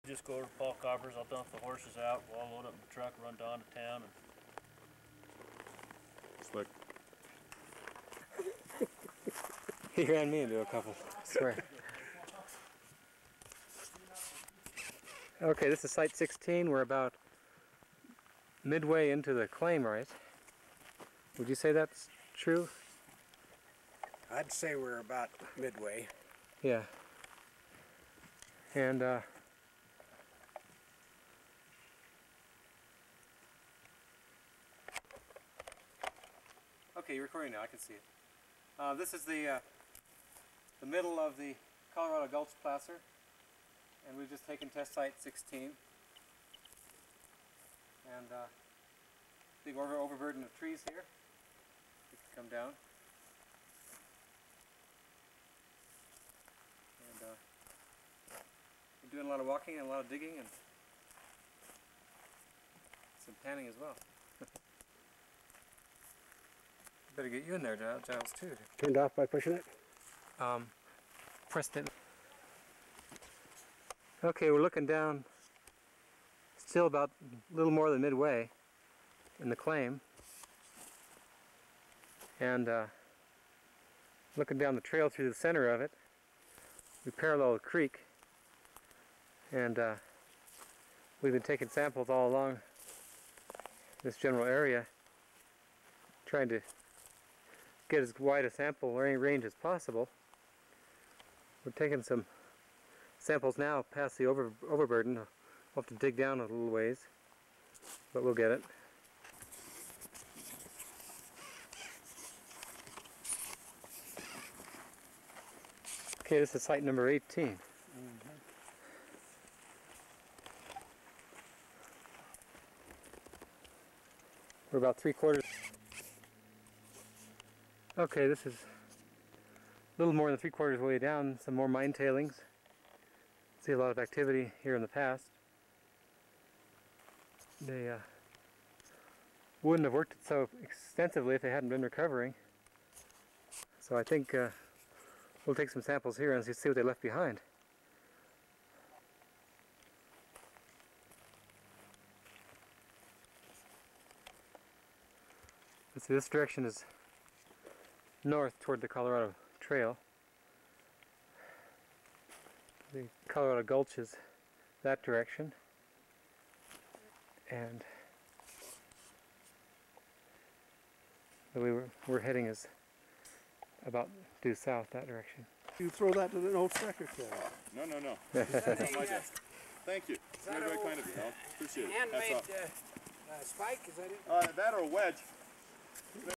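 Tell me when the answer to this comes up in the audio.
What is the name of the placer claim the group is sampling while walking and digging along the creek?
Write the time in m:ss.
0:41.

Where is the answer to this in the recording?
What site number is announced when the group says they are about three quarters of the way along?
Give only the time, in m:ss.
1:56.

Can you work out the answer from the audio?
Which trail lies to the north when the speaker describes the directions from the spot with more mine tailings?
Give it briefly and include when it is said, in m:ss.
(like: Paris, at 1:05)
Colorado Trail, at 2:38.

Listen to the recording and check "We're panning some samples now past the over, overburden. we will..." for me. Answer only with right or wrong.
wrong.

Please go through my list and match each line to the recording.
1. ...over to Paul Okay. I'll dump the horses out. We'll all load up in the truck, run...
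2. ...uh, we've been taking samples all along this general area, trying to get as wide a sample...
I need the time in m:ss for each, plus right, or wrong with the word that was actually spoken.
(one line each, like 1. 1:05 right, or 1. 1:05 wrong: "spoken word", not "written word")
1. 0:00 wrong: "Coppers", not "Okay"
2. 1:29 right.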